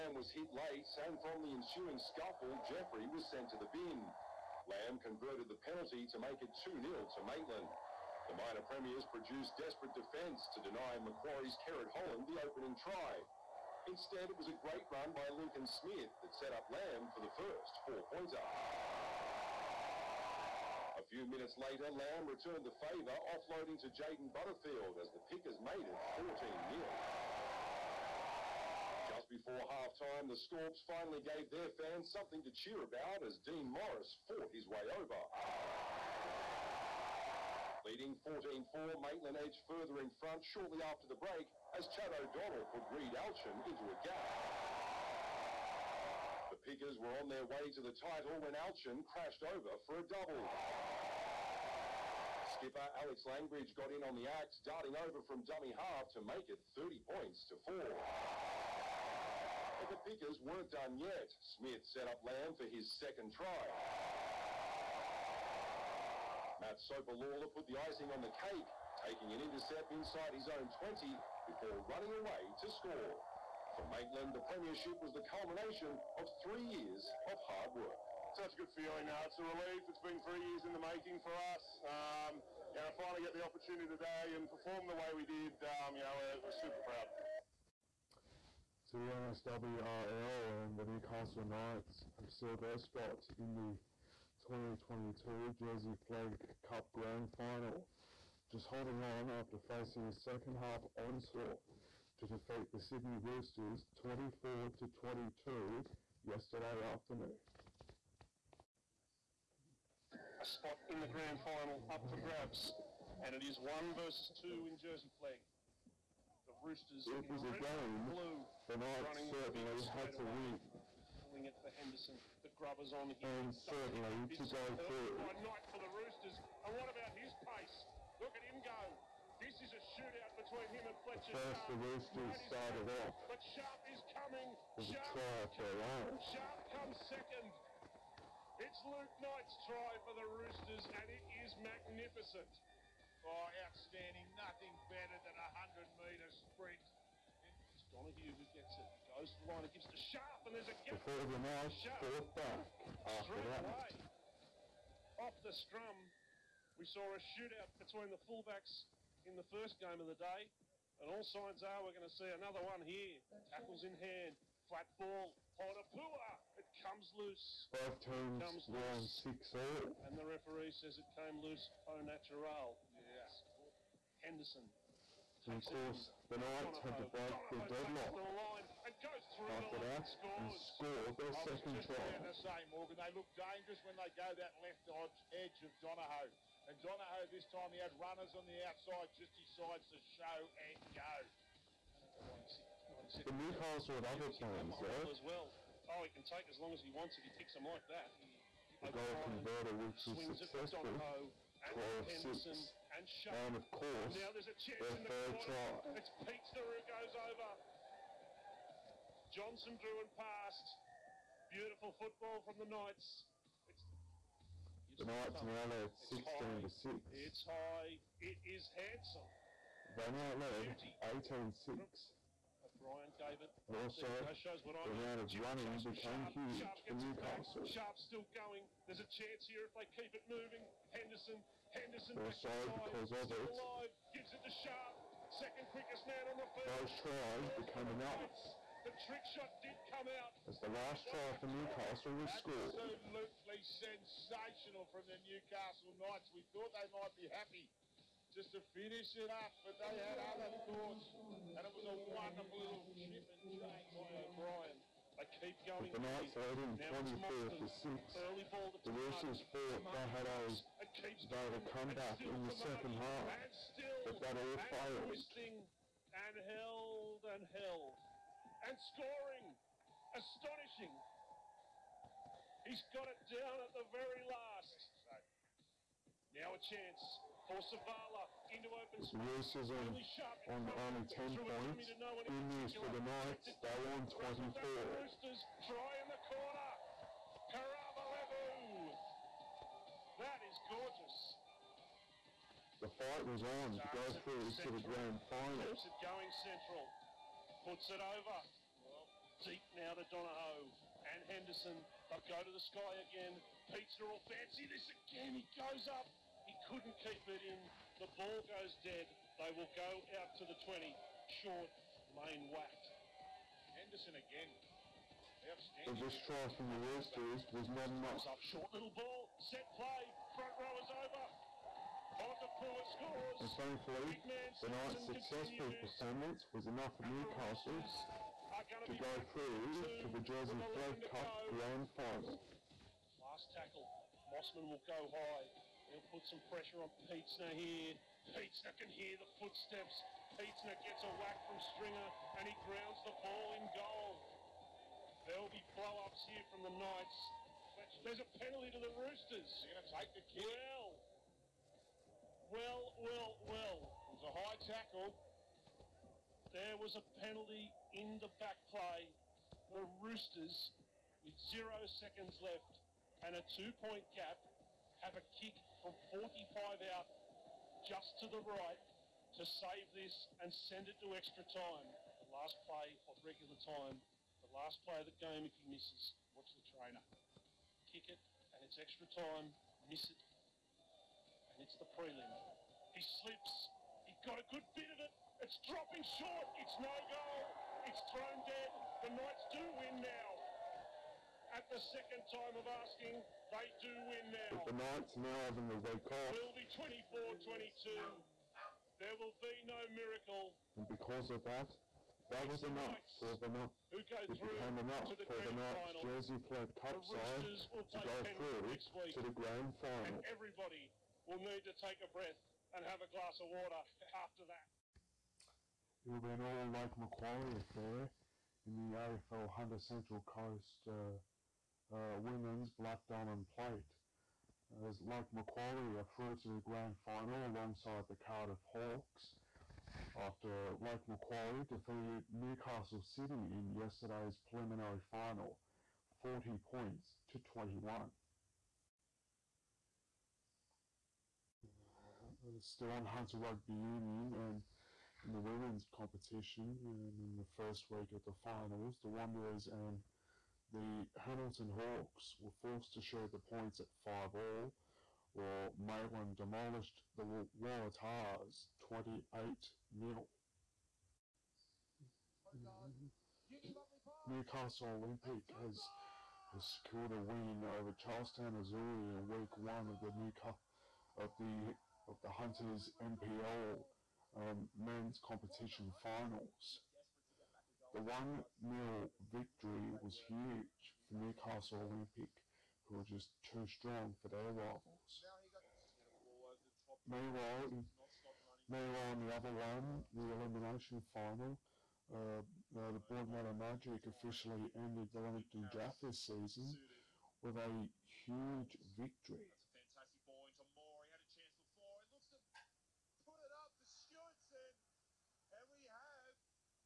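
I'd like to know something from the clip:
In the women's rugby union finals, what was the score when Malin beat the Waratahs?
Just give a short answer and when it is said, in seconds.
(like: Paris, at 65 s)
28-0, at 458 s.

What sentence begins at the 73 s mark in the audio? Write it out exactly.
For Maitland, the premiership was the culmination of three years of hard work.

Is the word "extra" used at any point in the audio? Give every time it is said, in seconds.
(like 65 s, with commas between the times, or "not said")
371 s, 378 s.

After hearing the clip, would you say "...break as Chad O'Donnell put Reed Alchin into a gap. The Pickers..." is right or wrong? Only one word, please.
right.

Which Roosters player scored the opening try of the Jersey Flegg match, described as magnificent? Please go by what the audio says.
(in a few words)
Luke Knight.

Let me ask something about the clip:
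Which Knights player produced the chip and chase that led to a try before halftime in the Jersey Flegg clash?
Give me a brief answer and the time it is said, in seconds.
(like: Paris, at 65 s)
O'Brien, at 254 s.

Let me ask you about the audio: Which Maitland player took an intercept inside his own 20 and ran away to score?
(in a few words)
Matt Lawler.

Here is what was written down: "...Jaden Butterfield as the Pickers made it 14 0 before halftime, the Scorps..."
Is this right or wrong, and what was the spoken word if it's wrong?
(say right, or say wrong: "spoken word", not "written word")
right.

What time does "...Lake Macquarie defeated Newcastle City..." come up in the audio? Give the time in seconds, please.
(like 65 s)
430 s.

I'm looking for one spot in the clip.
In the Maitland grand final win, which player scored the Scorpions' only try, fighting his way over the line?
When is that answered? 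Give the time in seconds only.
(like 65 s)
33 s.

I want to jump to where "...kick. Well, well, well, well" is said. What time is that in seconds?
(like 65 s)
350 s.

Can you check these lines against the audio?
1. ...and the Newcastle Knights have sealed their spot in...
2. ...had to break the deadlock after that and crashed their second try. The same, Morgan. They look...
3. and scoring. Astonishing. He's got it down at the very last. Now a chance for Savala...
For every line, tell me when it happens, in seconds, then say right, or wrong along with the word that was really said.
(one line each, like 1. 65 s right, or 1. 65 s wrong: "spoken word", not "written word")
1. 90 s right
2. 176 s wrong: "scored", not "crashed"
3. 268 s right.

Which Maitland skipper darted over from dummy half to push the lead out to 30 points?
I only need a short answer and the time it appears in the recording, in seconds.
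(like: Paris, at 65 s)
Alex Langbridge, at 52 s.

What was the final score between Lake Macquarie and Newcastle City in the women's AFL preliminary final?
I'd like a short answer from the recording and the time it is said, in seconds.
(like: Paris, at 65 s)
40 points to 21, at 436 s.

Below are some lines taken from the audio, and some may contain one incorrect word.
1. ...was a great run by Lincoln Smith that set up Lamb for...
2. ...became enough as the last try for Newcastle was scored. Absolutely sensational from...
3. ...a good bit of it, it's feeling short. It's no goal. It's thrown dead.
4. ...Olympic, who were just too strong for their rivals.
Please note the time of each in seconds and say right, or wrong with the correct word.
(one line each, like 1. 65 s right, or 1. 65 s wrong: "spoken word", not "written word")
1. 14 s right
2. 237 s right
3. 384 s wrong: "dropping", not "feeling"
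4. 481 s right.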